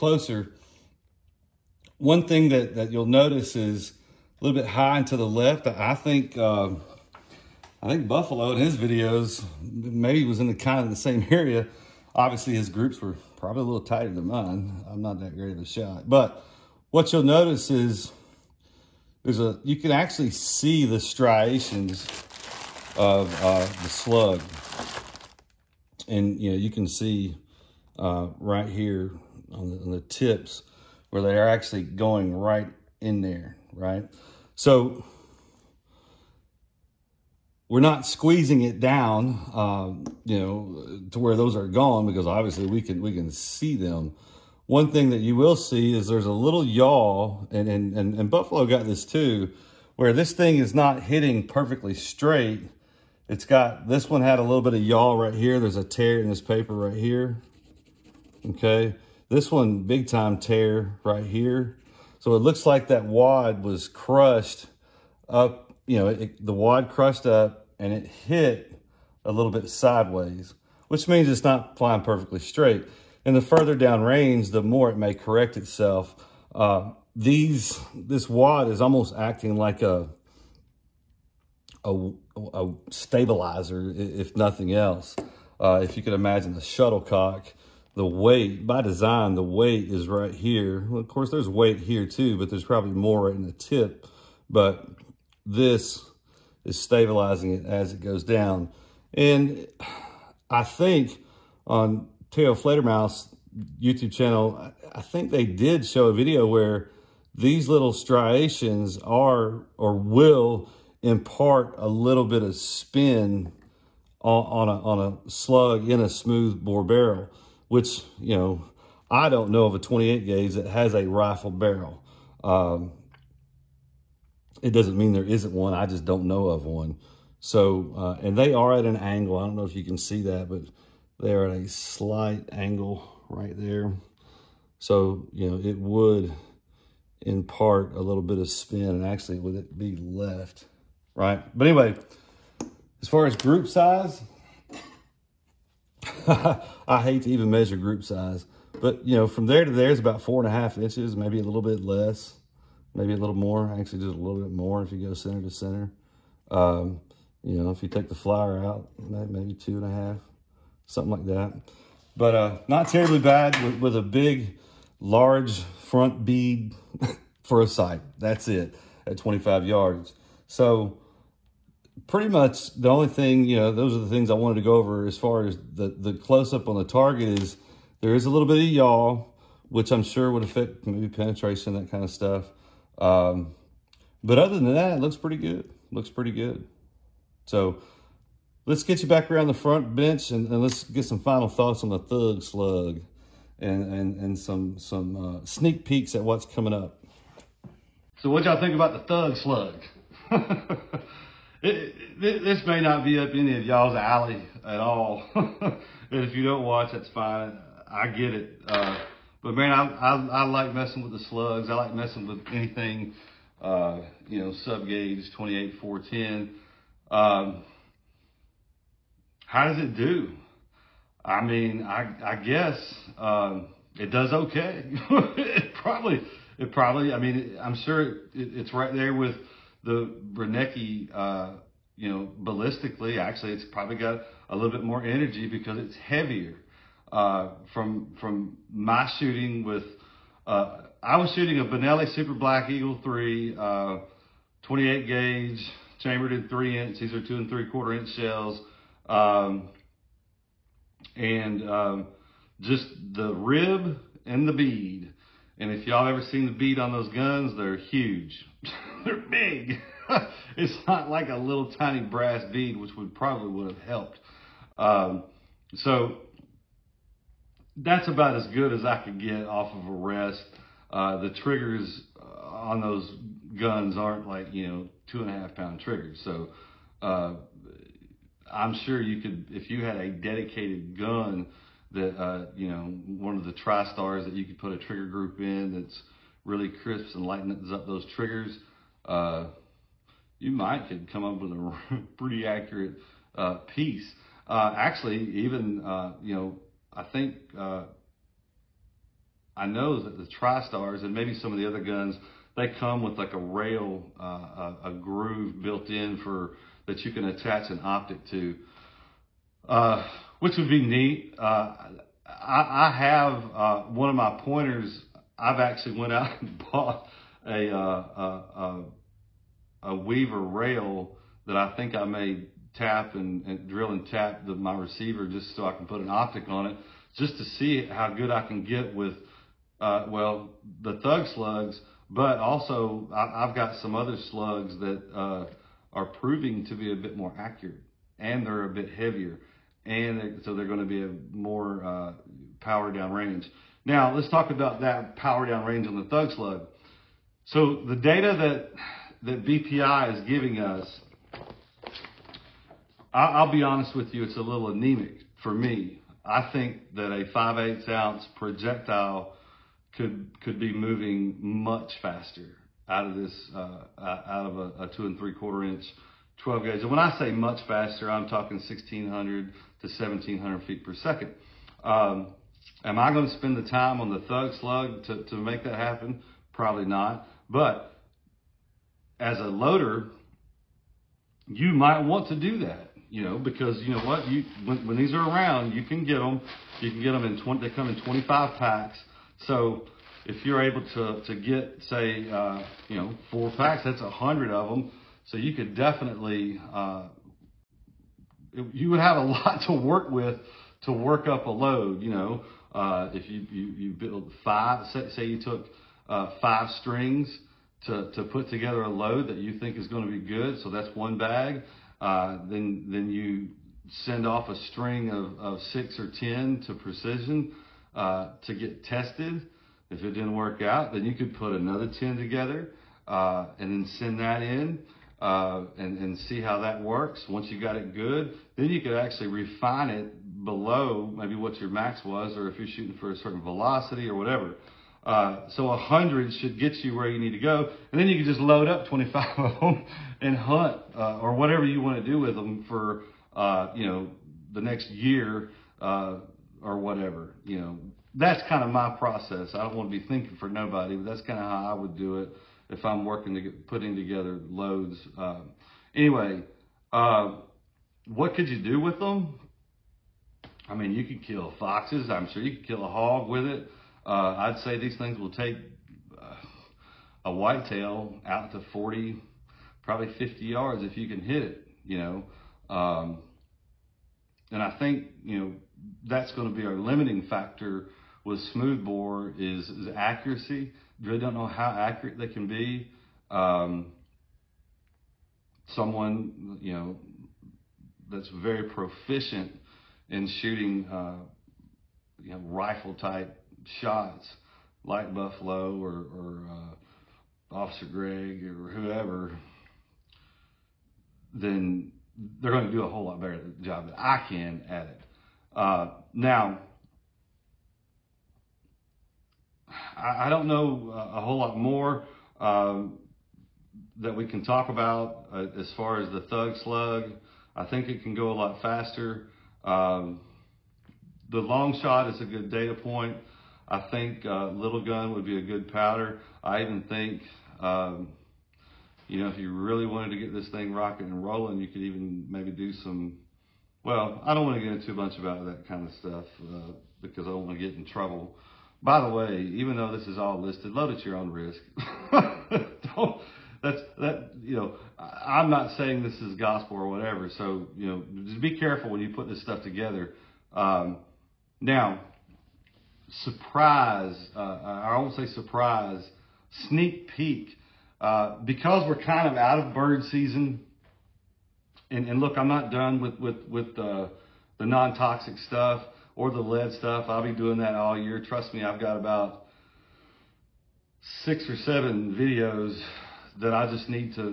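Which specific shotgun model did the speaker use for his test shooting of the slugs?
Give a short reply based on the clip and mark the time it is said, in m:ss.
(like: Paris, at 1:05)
Benelli Super Black Eagle 3, at 4:01.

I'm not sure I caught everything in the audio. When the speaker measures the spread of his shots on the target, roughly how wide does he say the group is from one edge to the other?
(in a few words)
4.5 inches.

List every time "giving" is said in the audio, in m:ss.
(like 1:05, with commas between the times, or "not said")
5:50.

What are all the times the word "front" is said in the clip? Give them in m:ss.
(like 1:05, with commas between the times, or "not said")
2:45, 3:09.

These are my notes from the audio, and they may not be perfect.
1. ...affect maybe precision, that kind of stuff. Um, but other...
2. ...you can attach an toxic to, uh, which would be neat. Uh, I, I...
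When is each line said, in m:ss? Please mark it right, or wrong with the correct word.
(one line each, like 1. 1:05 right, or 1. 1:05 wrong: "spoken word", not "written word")
1. 3:00 wrong: "penetration", not "precision"
2. 5:06 wrong: "optic", not "toxic".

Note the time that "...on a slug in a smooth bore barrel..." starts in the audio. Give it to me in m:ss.
1:54.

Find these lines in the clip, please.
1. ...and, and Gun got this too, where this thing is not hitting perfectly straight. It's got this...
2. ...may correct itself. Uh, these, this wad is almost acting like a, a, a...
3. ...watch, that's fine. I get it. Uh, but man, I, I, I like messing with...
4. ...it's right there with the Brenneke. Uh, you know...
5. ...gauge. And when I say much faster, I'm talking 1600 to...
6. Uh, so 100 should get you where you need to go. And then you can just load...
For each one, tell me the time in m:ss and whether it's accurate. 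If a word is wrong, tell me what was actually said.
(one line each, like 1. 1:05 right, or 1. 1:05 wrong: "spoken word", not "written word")
1. 0:47 wrong: "Buffalo", not "Gun"
2. 1:14 right
3. 3:26 right
4. 3:48 right
5. 6:06 right
6. 7:15 right.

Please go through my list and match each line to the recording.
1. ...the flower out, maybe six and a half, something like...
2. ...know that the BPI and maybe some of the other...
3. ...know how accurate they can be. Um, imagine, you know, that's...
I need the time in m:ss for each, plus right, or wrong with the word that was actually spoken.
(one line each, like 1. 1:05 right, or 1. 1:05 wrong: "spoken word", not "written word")
1. 2:38 wrong: "two", not "six"
2. 4:59 wrong: "TriStars", not "BPI"
3. 8:01 wrong: "someone", not "imagine".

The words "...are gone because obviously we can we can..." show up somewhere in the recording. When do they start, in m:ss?
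0:41.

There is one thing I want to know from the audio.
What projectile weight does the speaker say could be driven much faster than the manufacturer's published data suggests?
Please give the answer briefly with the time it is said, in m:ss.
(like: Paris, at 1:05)
5/8 ounce, at 5:57.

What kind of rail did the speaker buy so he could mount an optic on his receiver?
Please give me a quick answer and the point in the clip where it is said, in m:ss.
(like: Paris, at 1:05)
Weaver rail, at 5:19.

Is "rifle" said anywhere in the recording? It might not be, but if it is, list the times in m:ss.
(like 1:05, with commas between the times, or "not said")
2:01, 8:12.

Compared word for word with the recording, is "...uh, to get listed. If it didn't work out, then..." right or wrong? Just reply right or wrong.
wrong.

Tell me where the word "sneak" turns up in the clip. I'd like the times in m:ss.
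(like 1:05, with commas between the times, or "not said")
3:15, 9:16.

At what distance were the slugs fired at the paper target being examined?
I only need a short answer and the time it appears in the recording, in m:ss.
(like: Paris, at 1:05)
25 yards, at 2:49.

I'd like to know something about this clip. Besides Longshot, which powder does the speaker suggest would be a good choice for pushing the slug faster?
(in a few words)
Lil' Gun.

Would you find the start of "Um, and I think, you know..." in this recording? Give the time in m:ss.
7:52.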